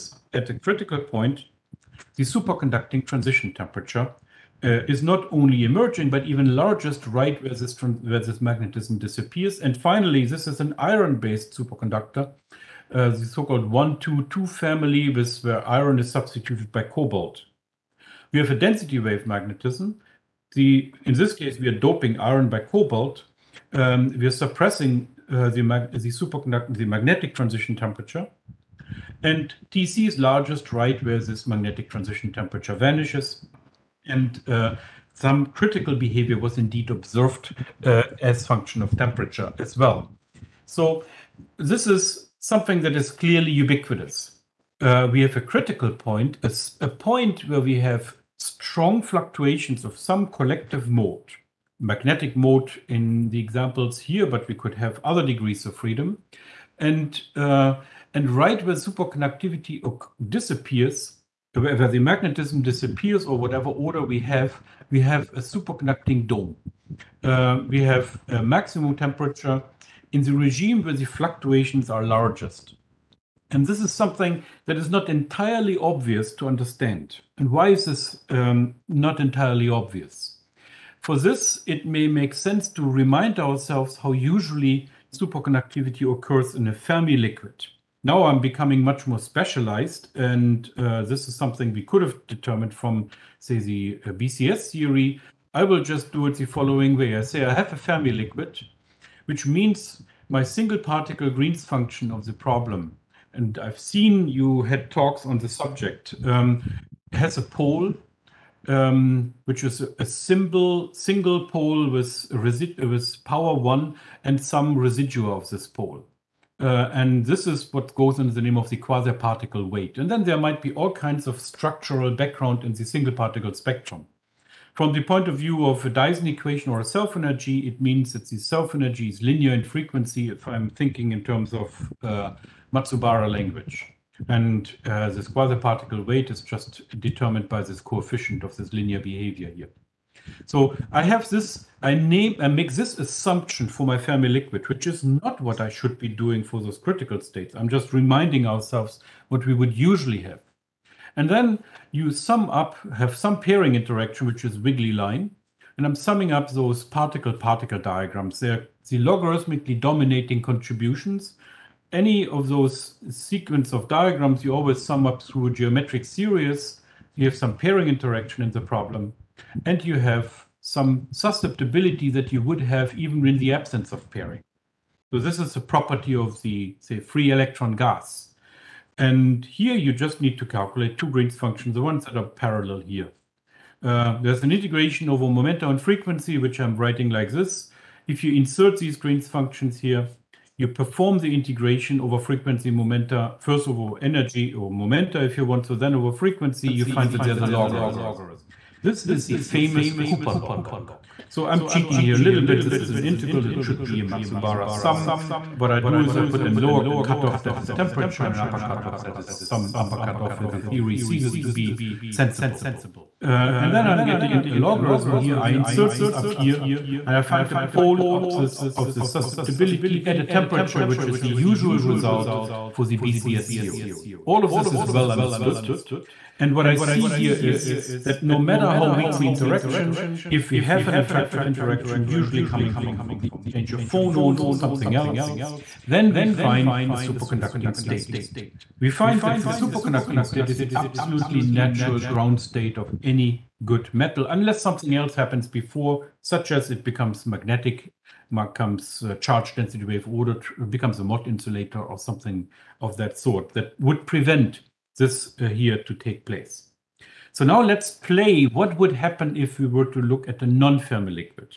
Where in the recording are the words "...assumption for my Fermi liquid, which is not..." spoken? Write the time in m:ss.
2:22.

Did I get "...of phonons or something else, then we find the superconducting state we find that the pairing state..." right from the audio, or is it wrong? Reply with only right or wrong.
wrong.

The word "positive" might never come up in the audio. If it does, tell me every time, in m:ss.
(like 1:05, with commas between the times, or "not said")
not said.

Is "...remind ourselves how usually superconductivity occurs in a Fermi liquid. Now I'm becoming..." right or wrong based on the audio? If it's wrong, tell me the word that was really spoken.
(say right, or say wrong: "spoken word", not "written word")
right.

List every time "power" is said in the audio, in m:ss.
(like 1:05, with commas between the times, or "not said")
1:53.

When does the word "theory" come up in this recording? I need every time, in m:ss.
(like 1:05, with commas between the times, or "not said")
1:34, 3:30, 3:43.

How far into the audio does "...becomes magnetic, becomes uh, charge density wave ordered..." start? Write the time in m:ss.
4:06.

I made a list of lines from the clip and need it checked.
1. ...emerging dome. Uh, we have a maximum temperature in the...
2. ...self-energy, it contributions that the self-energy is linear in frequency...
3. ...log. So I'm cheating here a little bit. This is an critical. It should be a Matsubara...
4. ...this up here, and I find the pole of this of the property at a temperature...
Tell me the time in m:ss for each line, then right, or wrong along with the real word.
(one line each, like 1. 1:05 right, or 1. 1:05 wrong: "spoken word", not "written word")
1. 1:05 wrong: "superconducting", not "emerging"
2. 2:06 wrong: "means", not "contributions"
3. 3:20 wrong: "integral", not "critical"
4. 3:35 wrong: "susceptibility", not "property".